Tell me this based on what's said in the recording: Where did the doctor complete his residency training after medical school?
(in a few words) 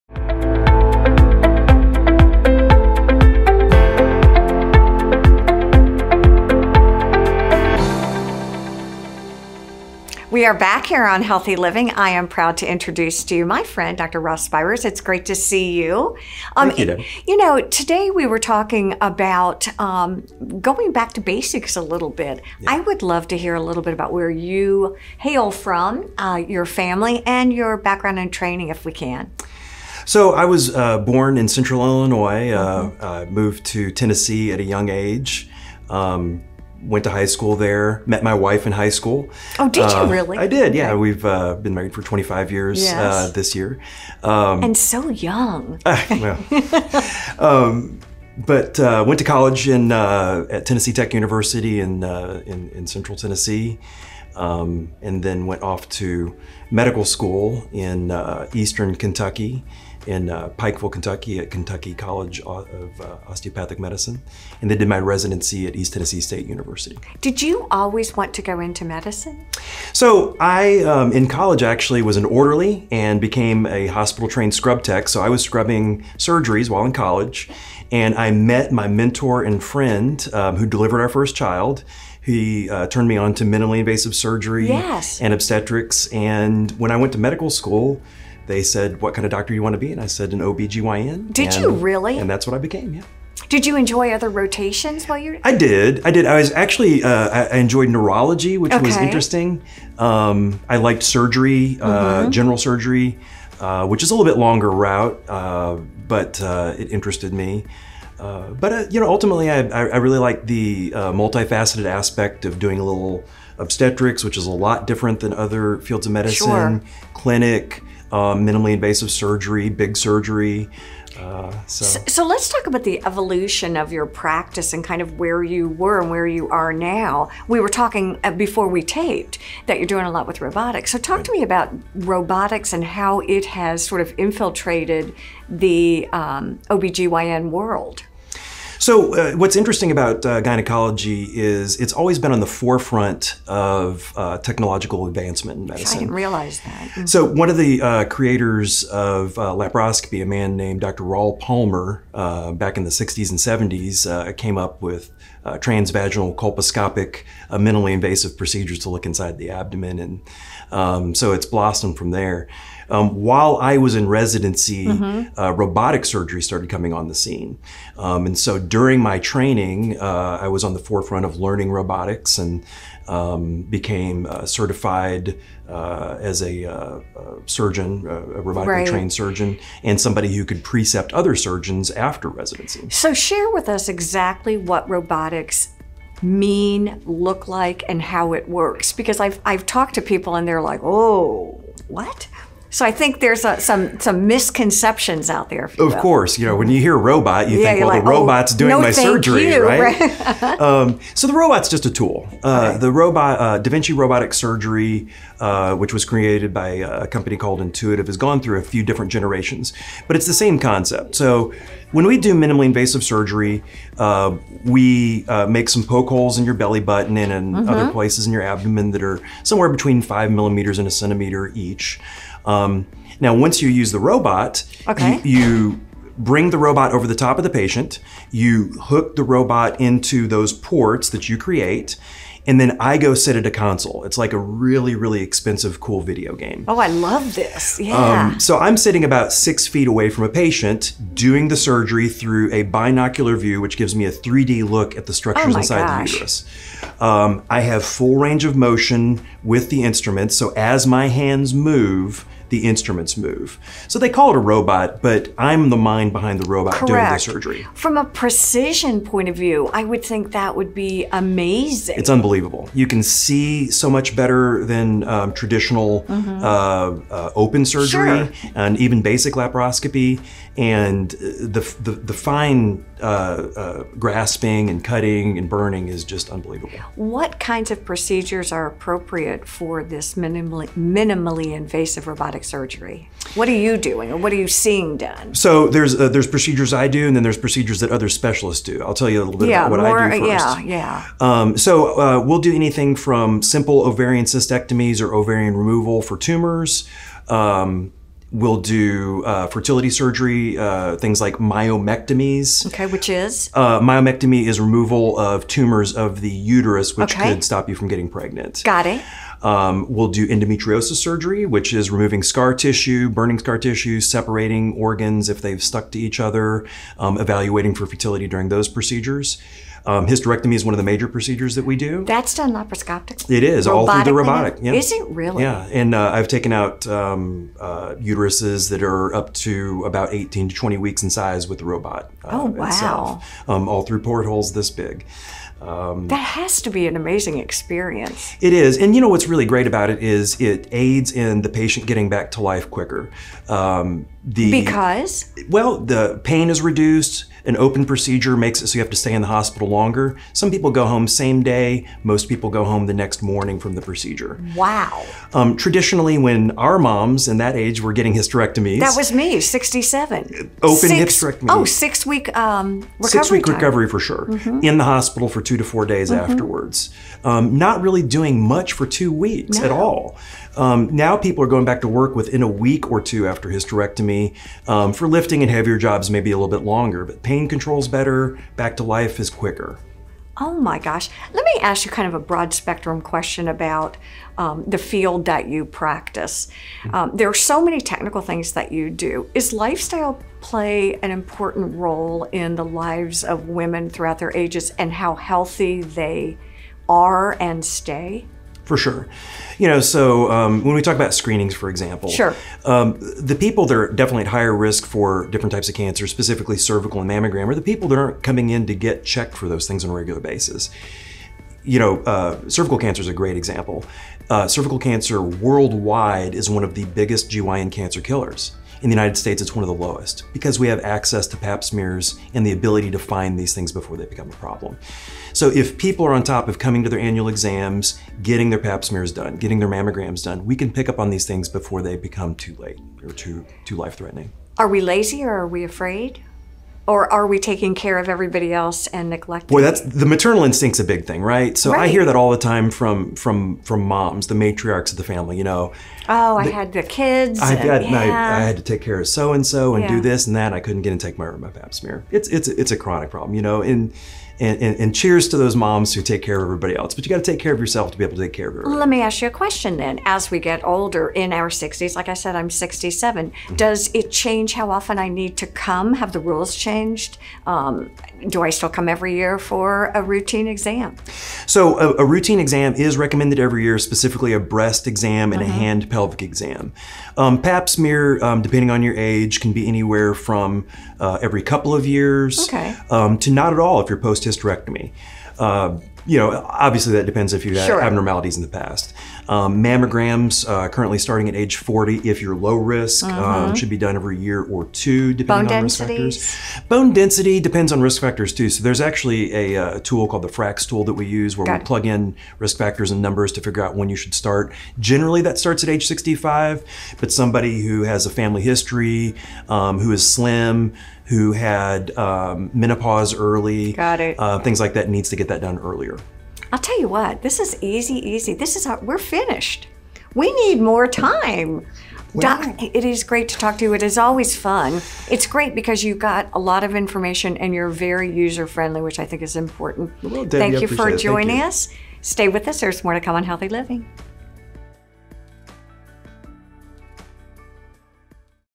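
East Tennessee State University.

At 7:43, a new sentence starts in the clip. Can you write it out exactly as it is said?
Does it change how often I need to come?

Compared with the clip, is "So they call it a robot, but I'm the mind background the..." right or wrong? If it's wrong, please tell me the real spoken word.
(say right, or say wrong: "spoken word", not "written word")
wrong: "behind", not "background".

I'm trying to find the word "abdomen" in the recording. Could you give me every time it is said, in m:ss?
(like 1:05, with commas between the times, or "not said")
2:39, 3:38.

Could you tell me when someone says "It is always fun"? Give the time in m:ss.
8:43.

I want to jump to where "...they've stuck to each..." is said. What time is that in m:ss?
5:15.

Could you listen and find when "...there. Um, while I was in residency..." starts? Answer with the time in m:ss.
2:42.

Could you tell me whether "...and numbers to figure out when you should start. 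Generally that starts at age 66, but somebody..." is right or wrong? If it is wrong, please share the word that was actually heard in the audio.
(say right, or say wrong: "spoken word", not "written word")
wrong: "65", not "66".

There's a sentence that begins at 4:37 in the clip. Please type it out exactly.
What kinds of procedures are appropriate for this minimally, minimally invasive robotic surgery?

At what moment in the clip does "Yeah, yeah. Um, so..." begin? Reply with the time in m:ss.
4:50.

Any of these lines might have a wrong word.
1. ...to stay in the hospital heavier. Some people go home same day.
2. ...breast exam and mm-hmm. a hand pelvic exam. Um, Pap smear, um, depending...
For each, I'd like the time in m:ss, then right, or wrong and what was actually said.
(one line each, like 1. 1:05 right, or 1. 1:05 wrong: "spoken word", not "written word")
1. 5:48 wrong: "longer", not "heavier"
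2. 7:54 right.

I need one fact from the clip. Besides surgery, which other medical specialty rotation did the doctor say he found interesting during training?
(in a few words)
neurology.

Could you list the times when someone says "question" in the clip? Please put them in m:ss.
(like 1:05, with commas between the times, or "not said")
6:23, 7:39.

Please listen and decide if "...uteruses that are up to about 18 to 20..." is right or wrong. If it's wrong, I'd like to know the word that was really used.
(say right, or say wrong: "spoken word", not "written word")
right.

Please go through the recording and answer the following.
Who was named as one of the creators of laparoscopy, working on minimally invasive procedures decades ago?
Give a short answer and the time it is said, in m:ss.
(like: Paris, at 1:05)
Dr. Raoul Palmer, at 2:30.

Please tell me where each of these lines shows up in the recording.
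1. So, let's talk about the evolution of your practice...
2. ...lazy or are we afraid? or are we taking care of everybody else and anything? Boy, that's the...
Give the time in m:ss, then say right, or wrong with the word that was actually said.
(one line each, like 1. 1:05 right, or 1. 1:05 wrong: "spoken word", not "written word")
1. 2:02 right
2. 7:14 wrong: "neglecting", not "anything".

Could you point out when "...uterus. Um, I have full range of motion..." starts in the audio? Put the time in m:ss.
4:06.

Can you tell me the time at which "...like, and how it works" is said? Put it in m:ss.
3:07.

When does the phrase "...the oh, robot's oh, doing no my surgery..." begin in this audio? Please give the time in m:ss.
3:18.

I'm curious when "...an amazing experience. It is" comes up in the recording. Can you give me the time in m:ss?
5:36.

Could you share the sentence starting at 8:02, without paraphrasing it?
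um, to not at all if you're post hysterectomy.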